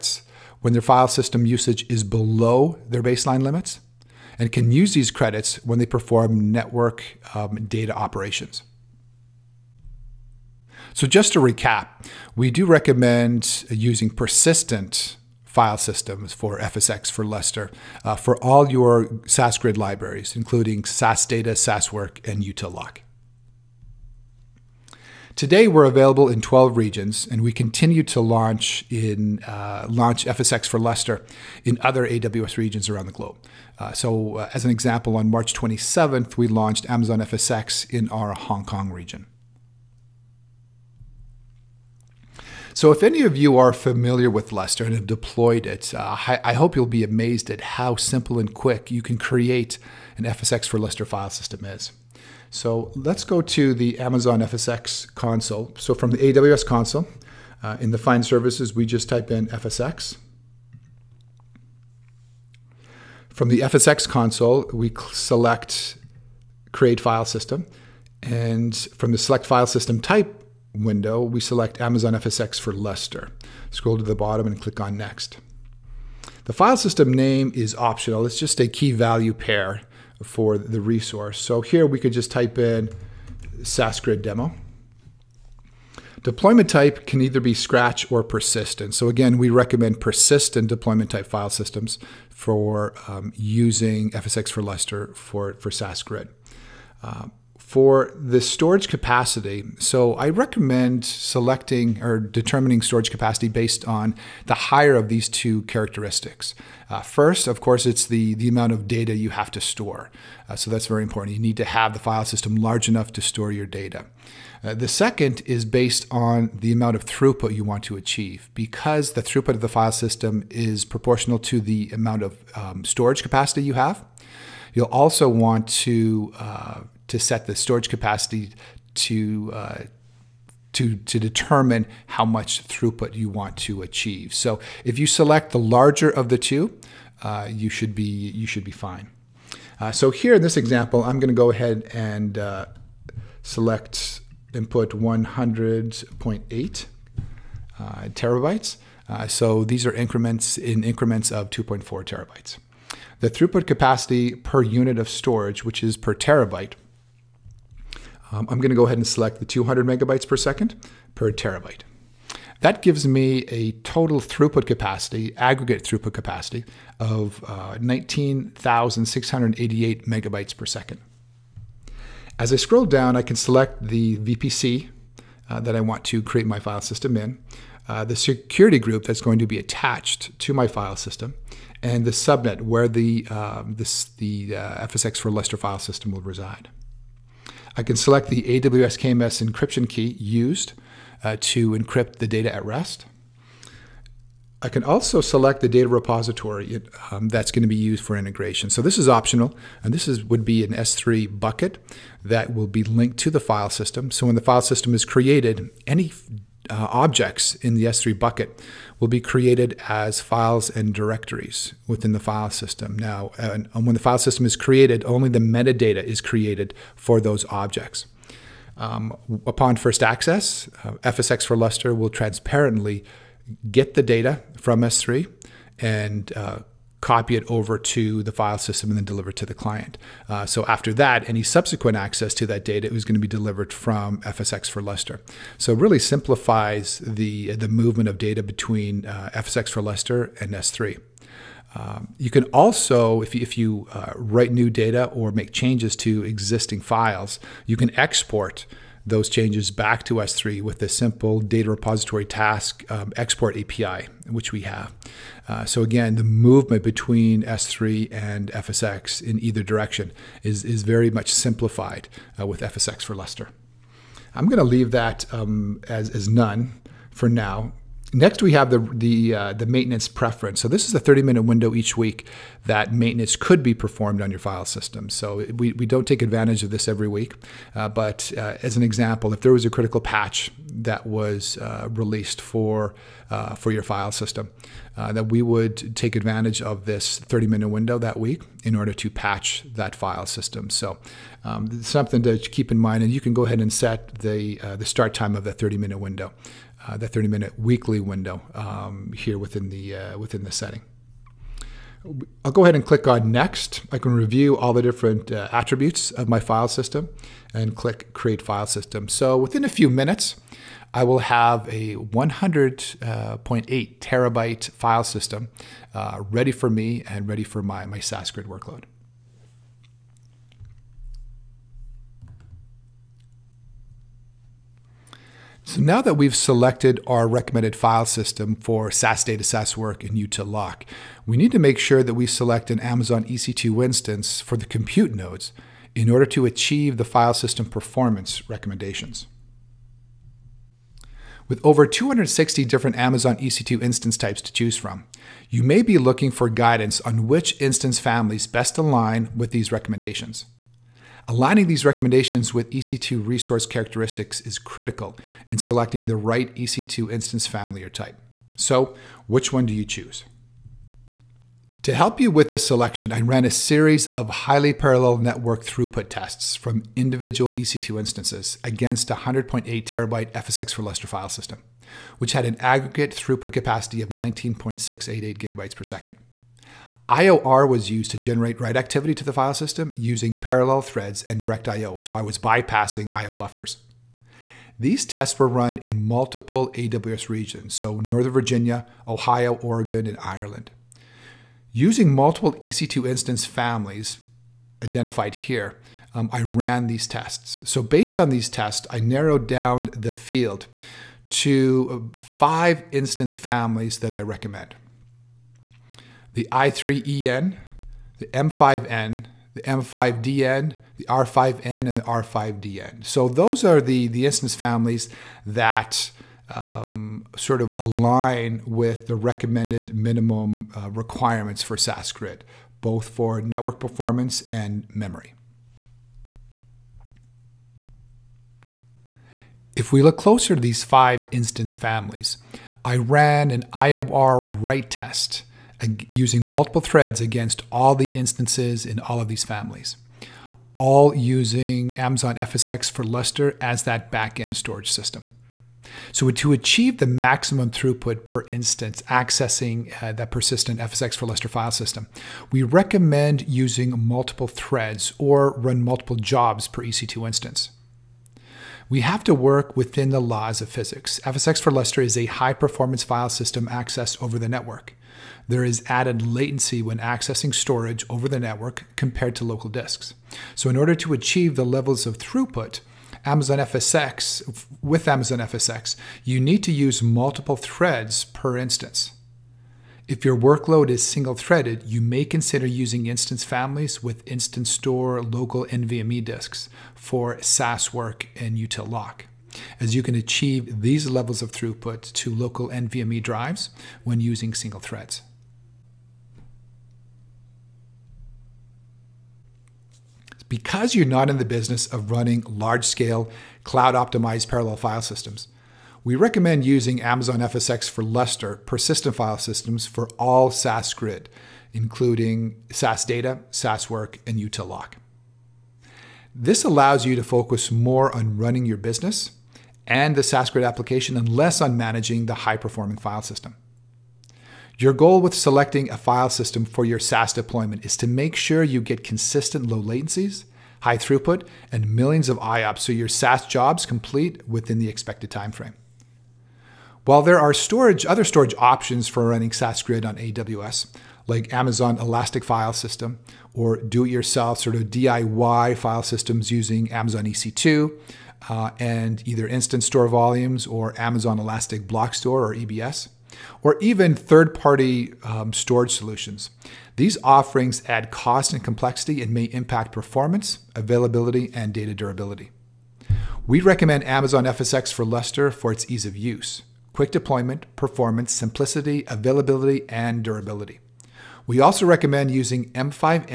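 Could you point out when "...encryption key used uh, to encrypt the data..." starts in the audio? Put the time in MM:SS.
03:09.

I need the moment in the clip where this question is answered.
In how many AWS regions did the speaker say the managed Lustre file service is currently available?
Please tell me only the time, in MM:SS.
00:26.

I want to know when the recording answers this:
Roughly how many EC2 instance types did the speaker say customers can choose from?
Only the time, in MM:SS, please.
05:41.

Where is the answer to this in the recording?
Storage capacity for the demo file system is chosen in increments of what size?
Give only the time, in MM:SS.
02:31.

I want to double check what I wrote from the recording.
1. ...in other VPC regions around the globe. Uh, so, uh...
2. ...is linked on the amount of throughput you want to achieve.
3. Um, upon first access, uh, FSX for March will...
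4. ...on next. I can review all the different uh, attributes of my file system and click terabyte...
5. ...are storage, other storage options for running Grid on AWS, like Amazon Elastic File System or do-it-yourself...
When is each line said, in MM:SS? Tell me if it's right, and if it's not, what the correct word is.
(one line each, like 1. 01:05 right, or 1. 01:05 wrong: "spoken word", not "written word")
1. 00:31 wrong: "AWS", not "VPC"
2. 01:55 wrong: "based", not "linked"
3. 03:38 wrong: "Lustre", not "March"
4. 05:03 wrong: "create", not "terabyte"
5. 08:57 right.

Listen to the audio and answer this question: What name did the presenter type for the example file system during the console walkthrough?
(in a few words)
SASGrid demo.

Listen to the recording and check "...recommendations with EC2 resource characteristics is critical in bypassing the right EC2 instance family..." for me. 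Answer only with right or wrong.
wrong.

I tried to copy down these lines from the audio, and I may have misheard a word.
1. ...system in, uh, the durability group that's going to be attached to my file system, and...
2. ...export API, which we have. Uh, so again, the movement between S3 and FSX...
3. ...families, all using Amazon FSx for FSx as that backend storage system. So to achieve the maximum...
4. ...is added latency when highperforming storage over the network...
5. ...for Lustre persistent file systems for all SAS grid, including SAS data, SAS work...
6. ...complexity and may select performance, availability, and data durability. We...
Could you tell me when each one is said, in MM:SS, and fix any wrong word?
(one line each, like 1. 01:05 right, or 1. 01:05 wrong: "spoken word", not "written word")
1. 02:56 wrong: "security", not "durability"
2. 04:13 right
3. 07:19 wrong: "Lustre", not "FSx"
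4. 07:45 wrong: "accessing", not "highperforming"
5. 08:27 right
6. 09:18 wrong: "impact", not "select".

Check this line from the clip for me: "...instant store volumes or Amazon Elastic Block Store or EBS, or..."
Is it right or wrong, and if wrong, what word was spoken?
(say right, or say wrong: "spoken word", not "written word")
right.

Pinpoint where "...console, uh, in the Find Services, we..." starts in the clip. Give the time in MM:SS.
00:56.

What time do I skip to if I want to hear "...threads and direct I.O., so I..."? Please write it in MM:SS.
06:20.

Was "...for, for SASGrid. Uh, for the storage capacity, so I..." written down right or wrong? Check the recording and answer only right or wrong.
right.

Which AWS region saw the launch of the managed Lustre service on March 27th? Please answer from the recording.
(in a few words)
Hong Kong.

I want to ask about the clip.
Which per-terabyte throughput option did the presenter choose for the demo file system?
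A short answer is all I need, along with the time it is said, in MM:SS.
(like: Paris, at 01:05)
200 megabytes per second, at 02:39.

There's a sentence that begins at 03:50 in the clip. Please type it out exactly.
Uh, so after that, any subsequent access to that data is going to be delivered from FSX for Lustre.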